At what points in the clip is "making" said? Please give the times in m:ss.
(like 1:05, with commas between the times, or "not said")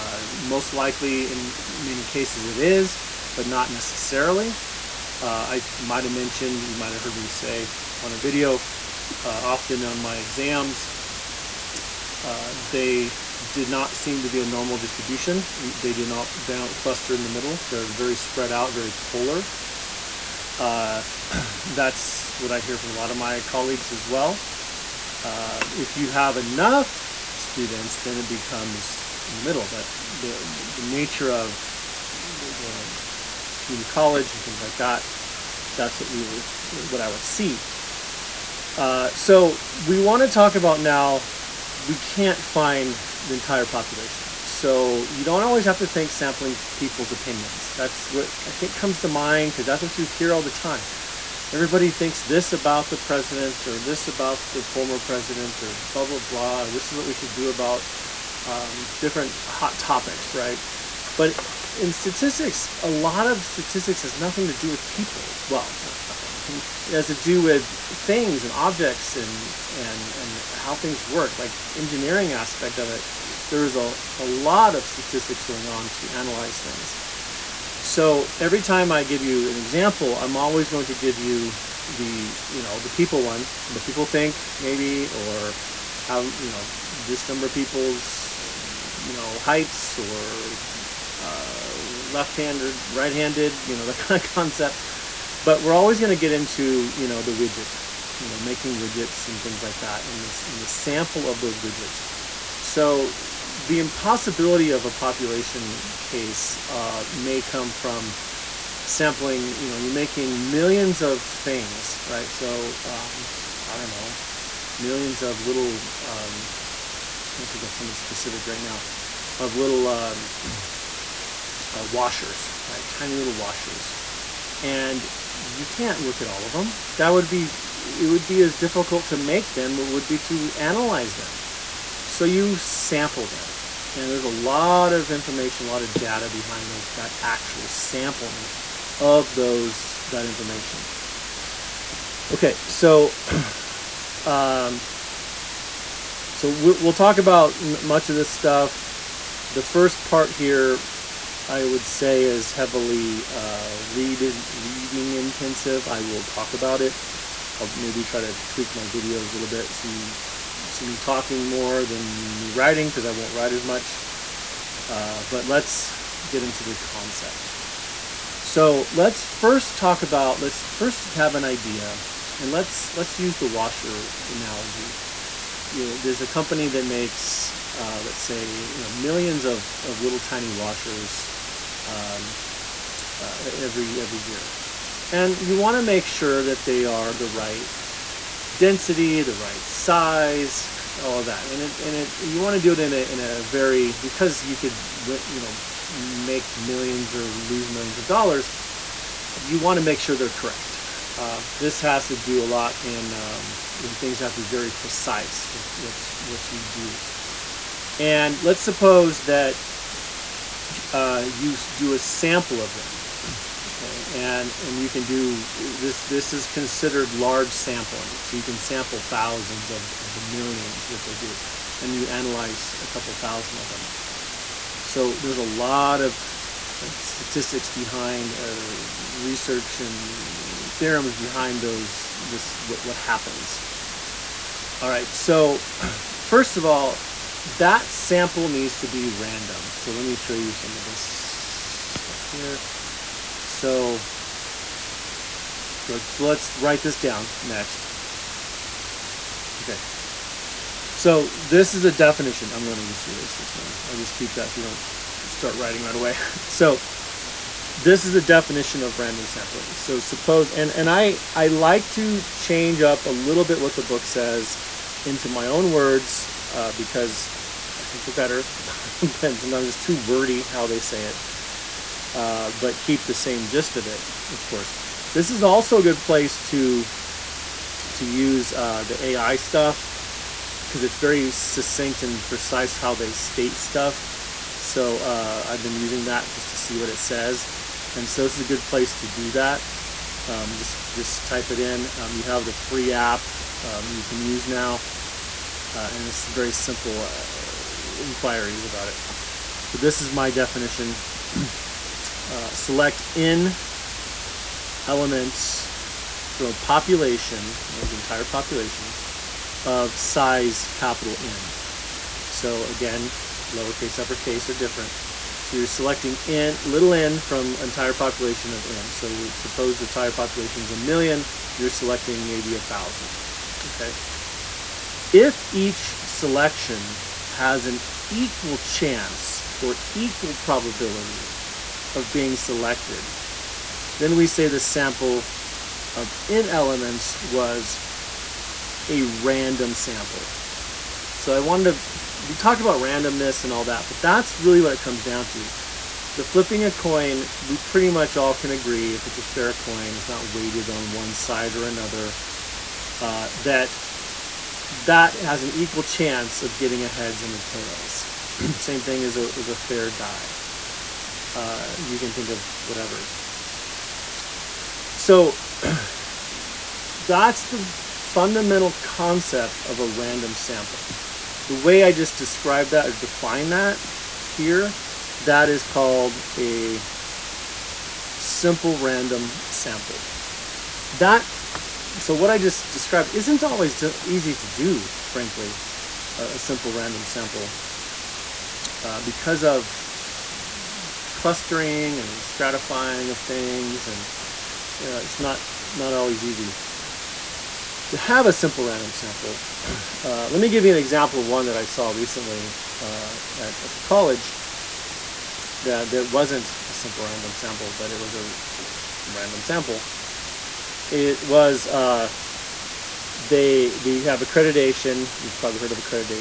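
1:38, 1:49.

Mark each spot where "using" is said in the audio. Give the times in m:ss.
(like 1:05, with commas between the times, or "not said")
4:45.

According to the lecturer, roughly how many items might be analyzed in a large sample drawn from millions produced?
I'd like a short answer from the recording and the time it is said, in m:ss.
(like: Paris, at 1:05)
a couple thousand, at 3:42.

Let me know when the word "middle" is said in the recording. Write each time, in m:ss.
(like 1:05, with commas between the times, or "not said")
0:17, 0:29.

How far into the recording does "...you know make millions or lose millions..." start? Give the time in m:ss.
3:15.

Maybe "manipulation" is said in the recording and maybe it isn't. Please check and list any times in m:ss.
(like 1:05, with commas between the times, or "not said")
not said.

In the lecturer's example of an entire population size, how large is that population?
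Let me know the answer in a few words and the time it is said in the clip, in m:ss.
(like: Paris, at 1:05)
a million, at 5:20.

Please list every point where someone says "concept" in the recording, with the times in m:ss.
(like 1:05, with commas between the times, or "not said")
1:34, 2:46, 6:08.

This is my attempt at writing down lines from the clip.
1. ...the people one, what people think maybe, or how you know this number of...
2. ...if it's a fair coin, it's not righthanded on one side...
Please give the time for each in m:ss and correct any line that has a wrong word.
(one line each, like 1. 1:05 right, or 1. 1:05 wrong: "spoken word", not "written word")
1. 1:22 right
2. 5:48 wrong: "weighted", not "righthanded".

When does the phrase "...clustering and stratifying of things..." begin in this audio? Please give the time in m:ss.
6:31.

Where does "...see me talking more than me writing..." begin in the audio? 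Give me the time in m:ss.
2:40.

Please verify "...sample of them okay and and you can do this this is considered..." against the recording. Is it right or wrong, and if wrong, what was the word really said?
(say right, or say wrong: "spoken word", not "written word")
right.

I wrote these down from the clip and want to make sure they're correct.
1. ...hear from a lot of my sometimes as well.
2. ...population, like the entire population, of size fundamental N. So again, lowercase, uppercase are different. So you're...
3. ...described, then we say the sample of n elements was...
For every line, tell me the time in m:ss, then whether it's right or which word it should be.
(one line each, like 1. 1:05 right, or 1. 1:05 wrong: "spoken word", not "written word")
1. 0:22 wrong: "colleagues", not "sometimes"
2. 5:06 wrong: "capital", not "fundamental"
3. 5:32 wrong: "selected", not "described".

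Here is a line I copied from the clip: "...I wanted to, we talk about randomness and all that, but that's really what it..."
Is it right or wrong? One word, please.
right.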